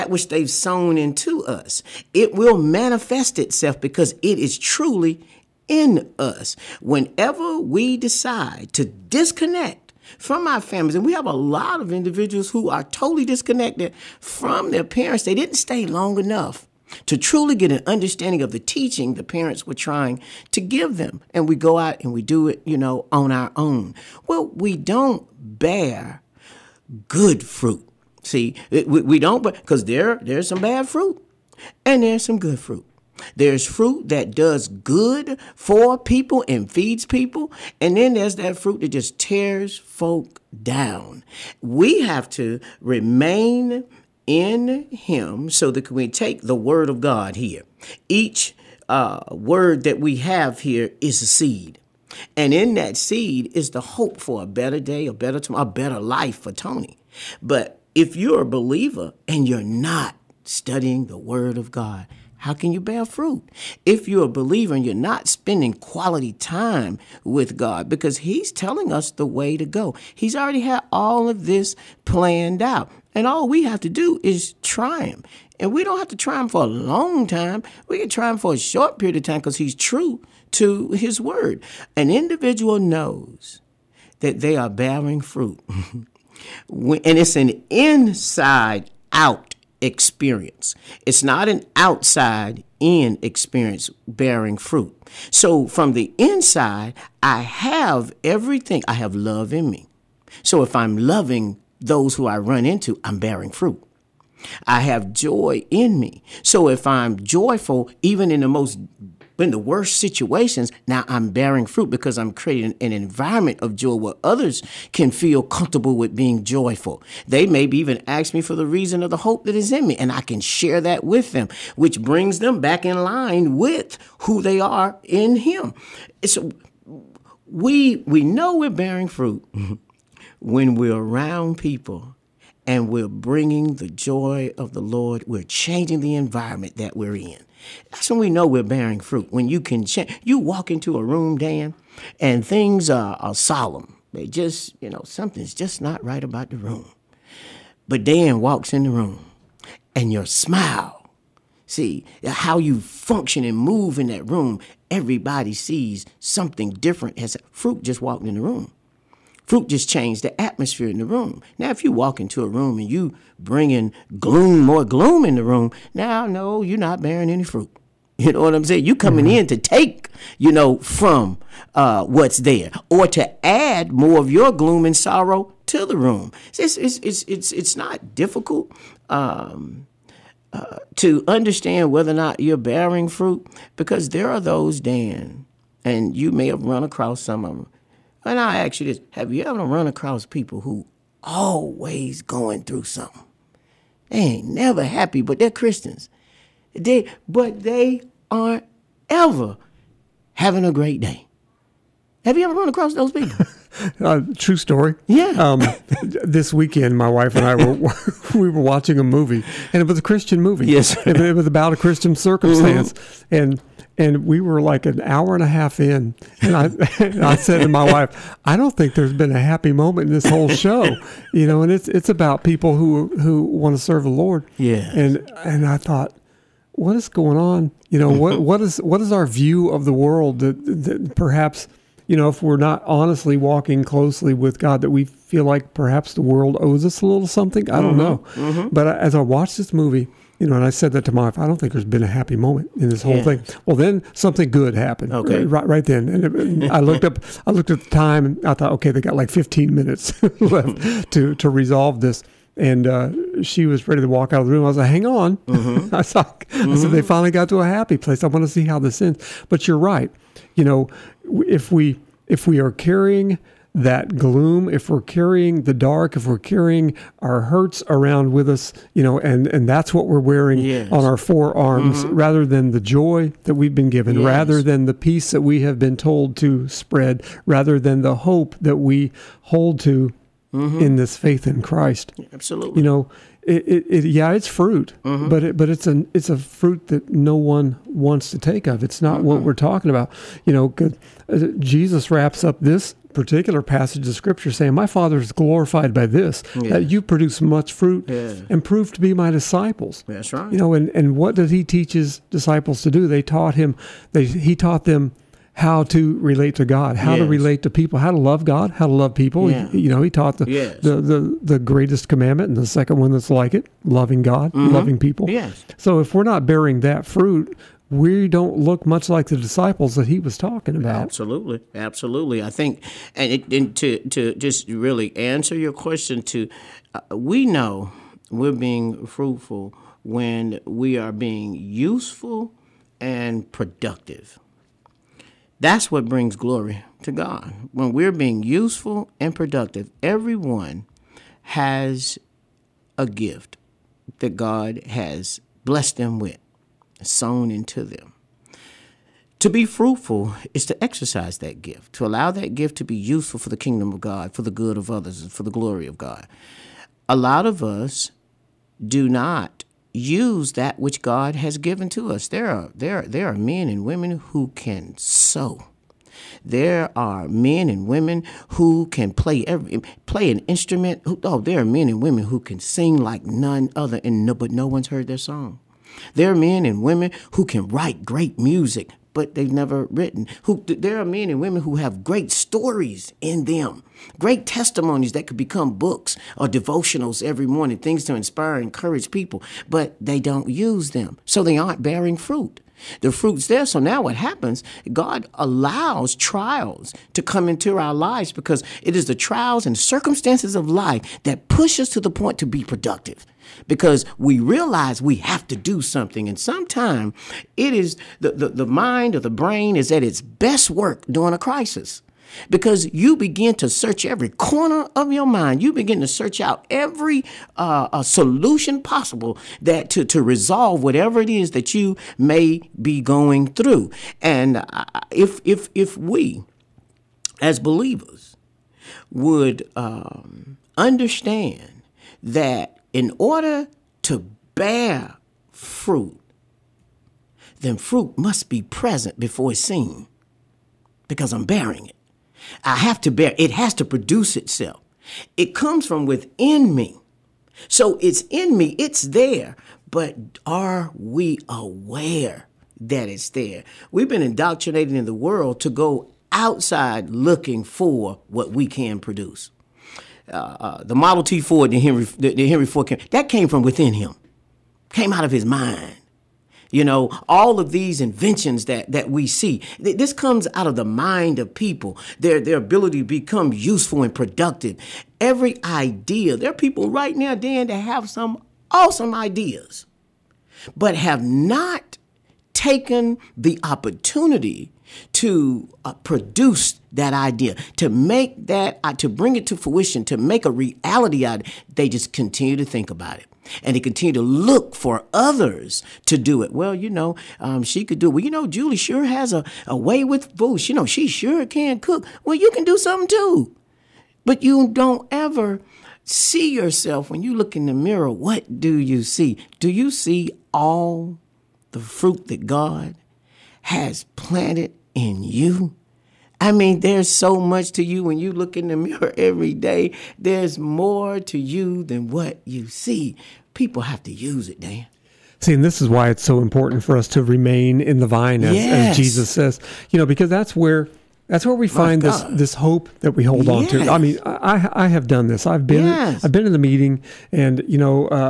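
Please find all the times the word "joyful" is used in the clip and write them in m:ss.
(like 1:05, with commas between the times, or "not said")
1:47, 1:56.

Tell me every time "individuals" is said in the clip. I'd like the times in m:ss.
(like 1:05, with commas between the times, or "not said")
0:11, 1:22.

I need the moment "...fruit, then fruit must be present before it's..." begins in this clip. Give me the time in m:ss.
7:15.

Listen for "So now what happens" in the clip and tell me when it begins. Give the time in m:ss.
6:33.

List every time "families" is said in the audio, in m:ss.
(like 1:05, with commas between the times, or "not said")
0:10.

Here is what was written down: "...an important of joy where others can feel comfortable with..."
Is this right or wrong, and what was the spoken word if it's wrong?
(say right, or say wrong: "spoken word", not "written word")
wrong: "environment", not "important".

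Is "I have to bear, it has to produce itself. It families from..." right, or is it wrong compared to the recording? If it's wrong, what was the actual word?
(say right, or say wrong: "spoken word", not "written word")
wrong: "comes", not "families".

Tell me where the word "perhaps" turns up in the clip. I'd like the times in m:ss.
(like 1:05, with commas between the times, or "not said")
3:51, 3:55.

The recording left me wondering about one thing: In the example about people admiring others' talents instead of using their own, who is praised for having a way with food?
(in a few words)
Julie.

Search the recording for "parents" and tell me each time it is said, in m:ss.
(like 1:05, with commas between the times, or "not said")
0:14, 0:19.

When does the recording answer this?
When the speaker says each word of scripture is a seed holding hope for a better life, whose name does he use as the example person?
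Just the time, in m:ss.
0:56.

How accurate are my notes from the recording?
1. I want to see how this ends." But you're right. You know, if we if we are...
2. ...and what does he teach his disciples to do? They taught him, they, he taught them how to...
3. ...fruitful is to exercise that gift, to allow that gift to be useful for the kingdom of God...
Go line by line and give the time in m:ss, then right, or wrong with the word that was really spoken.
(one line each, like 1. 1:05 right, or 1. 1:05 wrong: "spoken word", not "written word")
1. 4:18 right
2. 5:00 right
3. 5:49 right.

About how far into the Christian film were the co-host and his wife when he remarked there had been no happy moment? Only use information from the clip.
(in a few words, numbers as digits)
an hour and a half.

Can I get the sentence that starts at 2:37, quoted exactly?
As fruit just walked in the room.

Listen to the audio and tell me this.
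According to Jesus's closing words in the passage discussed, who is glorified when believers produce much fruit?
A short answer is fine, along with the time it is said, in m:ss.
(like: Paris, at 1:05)
My Father, at 4:54.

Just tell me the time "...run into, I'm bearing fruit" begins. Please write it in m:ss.
1:42.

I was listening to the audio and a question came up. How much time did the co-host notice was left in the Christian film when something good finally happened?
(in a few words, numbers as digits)
15 minutes.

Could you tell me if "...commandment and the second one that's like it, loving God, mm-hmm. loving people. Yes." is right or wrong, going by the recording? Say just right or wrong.
right.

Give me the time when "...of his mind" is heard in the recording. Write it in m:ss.
7:45.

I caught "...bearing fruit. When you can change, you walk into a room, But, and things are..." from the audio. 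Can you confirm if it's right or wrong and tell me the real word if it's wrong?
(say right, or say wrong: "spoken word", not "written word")
wrong: "Dan", not "But".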